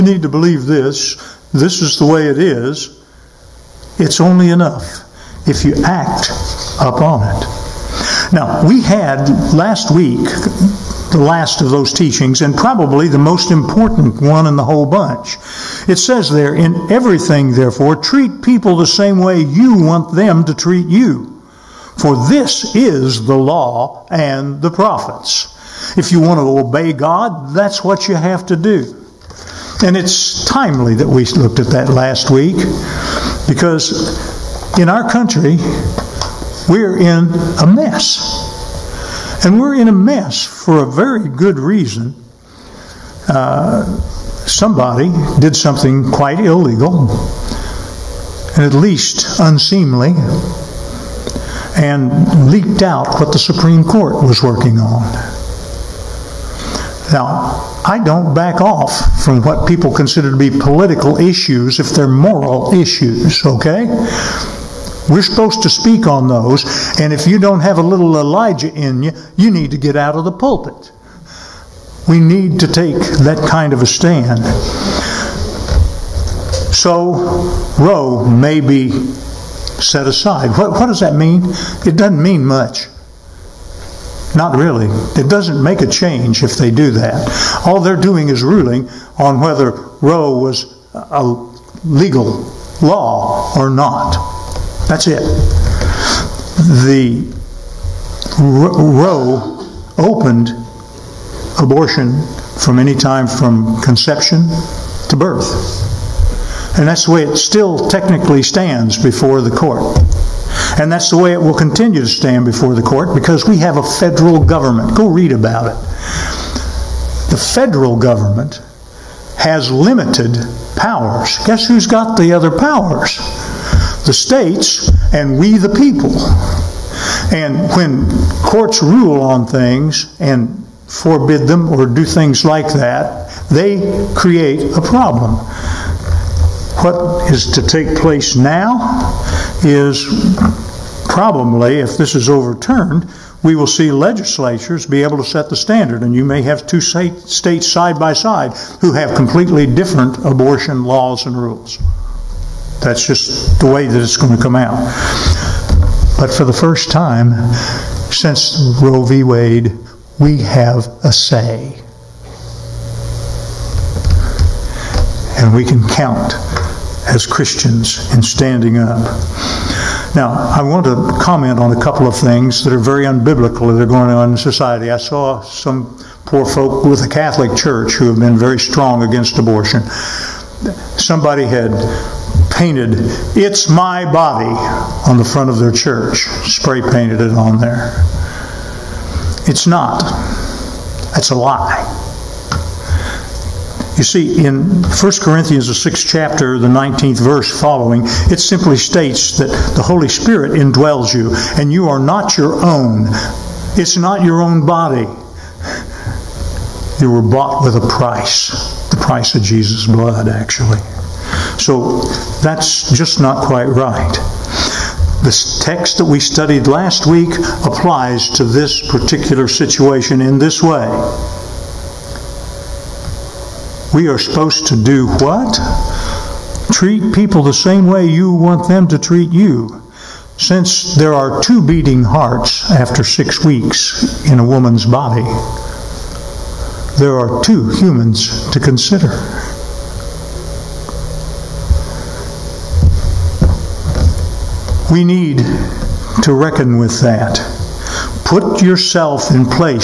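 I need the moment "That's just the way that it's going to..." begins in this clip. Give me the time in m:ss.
2:32.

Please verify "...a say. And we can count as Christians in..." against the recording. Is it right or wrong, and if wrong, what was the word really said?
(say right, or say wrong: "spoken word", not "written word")
right.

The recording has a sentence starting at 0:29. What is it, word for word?
And it's timely that we looked at that last week because in our country, we're in a mess.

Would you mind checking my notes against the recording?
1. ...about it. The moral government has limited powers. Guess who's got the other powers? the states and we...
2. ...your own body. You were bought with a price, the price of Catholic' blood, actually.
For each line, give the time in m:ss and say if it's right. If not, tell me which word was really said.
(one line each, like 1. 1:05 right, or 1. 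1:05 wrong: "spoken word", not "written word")
1. 1:55 wrong: "federal", not "moral"
2. 3:24 wrong: "Jesus", not "Catholic".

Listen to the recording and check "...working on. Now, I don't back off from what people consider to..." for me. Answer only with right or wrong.
right.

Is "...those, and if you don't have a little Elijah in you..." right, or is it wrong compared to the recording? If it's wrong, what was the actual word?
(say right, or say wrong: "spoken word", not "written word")
right.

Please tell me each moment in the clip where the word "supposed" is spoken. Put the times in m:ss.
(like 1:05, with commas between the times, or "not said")
1:05, 3:44.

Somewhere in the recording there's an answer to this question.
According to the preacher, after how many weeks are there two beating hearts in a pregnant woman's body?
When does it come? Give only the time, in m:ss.
3:53.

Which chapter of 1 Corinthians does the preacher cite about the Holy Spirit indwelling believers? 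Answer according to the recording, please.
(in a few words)
6th.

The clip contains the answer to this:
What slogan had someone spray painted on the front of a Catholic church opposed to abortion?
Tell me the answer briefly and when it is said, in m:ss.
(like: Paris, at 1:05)
It's My Body, at 3:03.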